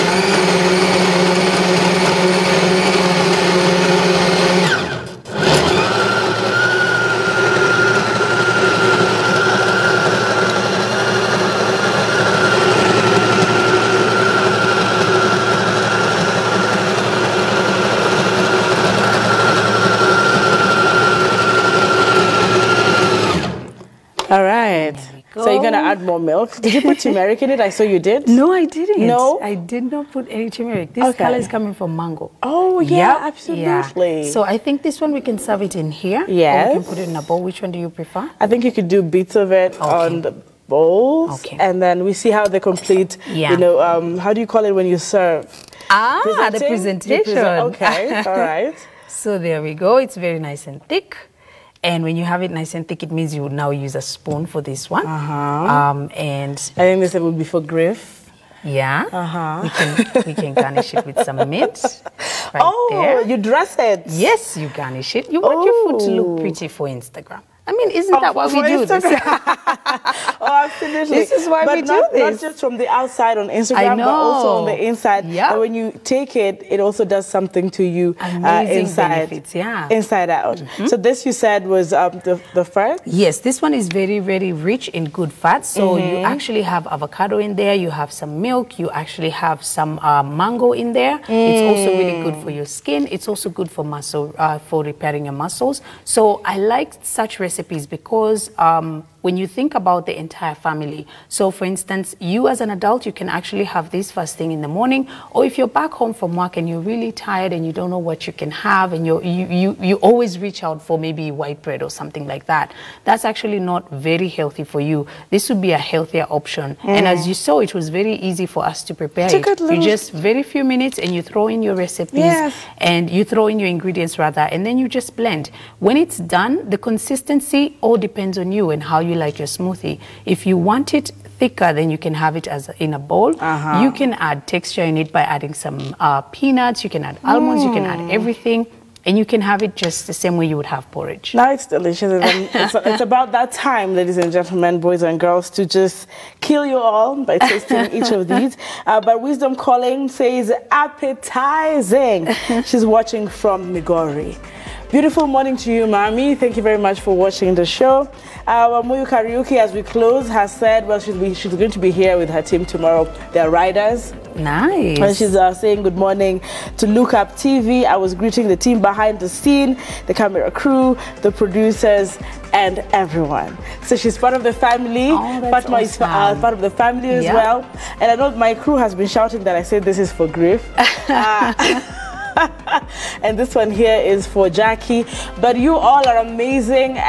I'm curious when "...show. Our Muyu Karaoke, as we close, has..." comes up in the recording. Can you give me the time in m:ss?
2:37.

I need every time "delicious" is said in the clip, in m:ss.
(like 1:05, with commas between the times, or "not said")
2:21.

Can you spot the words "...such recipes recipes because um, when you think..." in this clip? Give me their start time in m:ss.
1:37.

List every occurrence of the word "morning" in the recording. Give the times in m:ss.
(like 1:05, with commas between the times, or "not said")
1:44, 2:35, 2:45.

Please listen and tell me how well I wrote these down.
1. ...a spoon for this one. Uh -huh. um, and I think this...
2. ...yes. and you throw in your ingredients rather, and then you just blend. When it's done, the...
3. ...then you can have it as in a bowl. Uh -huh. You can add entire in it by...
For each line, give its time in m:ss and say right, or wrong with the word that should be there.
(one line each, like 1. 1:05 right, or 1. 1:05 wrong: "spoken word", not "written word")
1. 0:53 right
2. 2:02 right
3. 2:11 wrong: "texture", not "entire".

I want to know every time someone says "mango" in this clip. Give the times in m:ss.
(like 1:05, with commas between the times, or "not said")
0:32, 1:30.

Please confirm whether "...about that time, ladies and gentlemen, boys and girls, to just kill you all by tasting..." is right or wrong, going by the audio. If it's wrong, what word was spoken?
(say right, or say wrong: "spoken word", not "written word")
right.